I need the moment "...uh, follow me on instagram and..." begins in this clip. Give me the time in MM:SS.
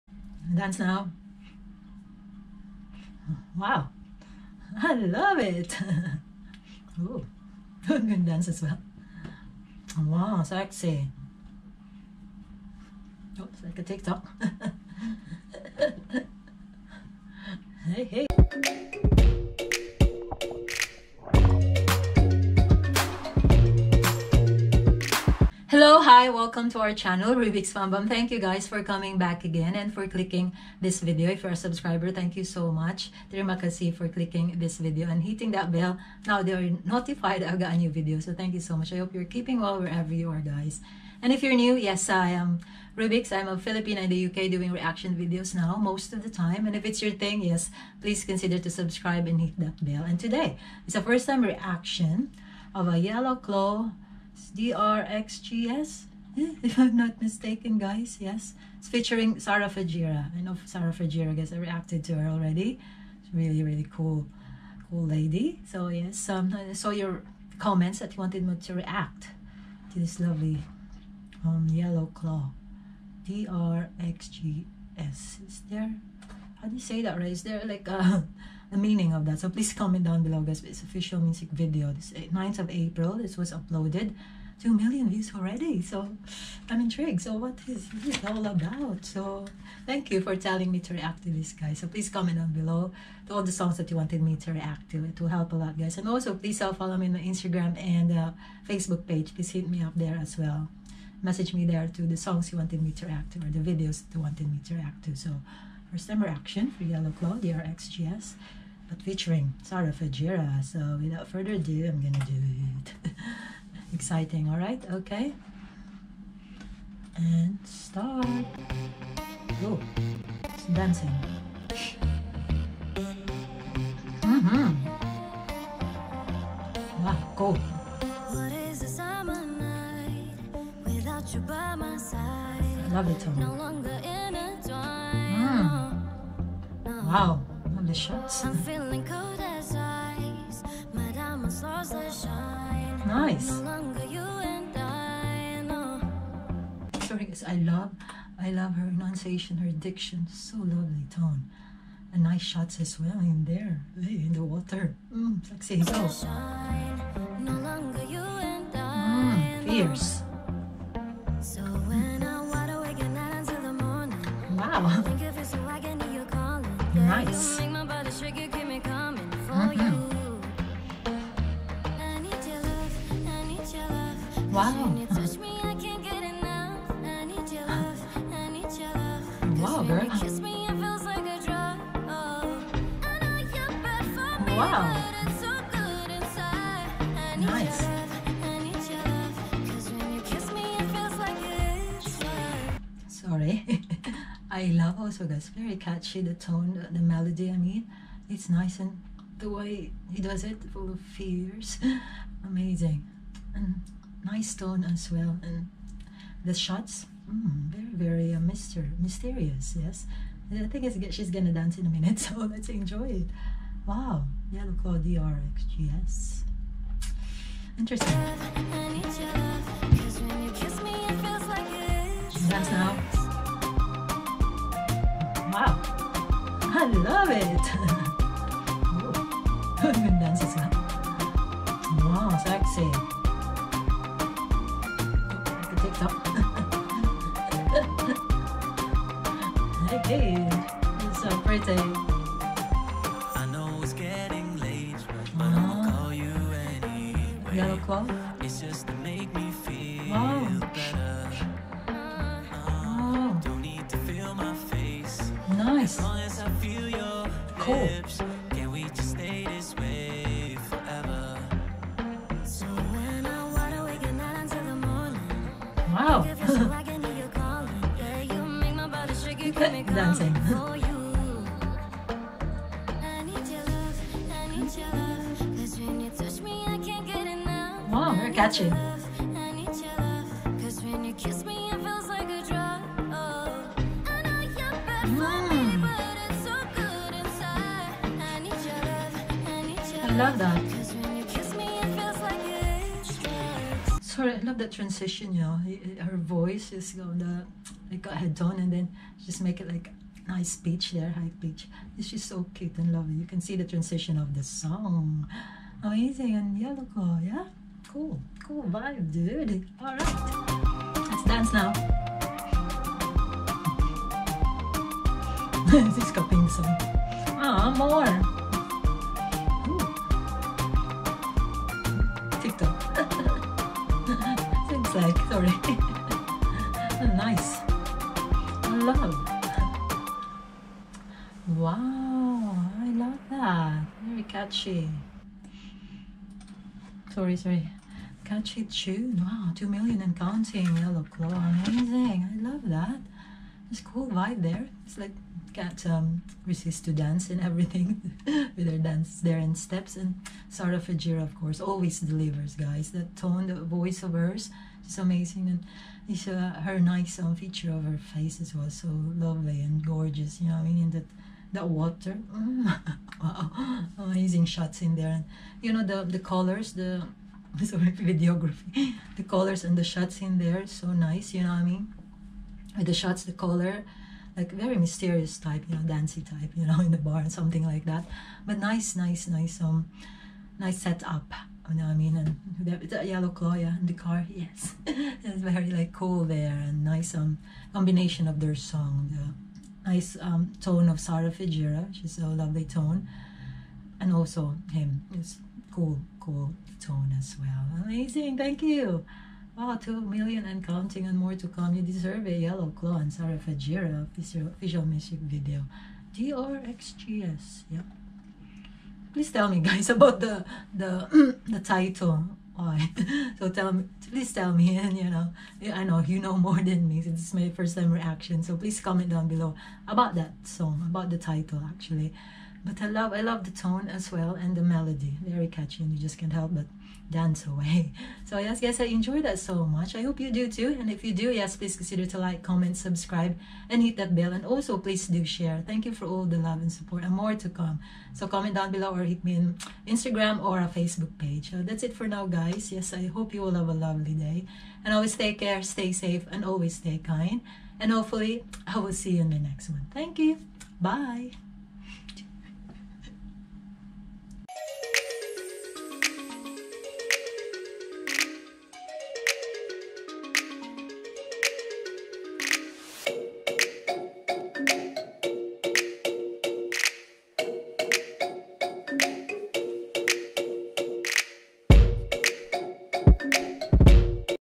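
01:36.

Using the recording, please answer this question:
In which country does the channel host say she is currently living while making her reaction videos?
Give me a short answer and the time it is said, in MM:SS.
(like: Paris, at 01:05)
UK, at 00:44.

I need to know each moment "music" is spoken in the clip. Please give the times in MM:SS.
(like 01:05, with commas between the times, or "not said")
01:21, 06:44.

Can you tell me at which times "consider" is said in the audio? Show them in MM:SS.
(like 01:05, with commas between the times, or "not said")
00:48, 07:11.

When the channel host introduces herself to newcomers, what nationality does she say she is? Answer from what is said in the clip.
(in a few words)
Filipina.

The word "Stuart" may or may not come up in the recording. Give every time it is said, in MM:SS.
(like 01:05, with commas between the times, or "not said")
not said.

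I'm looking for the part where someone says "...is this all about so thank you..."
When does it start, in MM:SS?
01:27.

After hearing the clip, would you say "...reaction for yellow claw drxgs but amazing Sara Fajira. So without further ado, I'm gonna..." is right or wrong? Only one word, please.
wrong.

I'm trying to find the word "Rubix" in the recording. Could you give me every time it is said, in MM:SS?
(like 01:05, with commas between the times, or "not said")
00:27, 00:42.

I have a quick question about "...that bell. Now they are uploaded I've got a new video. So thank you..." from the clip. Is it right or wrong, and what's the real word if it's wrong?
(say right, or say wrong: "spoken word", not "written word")
wrong: "notified", not "uploaded".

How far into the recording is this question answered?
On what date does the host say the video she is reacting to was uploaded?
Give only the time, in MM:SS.
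01:22.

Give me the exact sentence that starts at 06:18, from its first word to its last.
But nice, nice, nice, um, nice setup you know what I mean?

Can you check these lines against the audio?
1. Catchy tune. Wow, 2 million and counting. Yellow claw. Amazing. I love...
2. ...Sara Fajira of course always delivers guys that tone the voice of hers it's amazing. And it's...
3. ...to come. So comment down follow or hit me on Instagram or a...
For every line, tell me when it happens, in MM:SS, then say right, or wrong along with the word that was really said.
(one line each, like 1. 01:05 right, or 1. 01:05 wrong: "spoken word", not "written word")
1. 05:38 right
2. 05:50 right
3. 07:17 wrong: "below", not "follow".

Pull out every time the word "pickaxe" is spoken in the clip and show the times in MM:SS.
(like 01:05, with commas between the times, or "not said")
not said.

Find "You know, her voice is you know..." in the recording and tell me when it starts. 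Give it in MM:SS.
04:55.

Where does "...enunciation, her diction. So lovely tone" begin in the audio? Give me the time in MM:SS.
02:28.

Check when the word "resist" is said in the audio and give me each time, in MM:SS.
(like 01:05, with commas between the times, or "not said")
05:46.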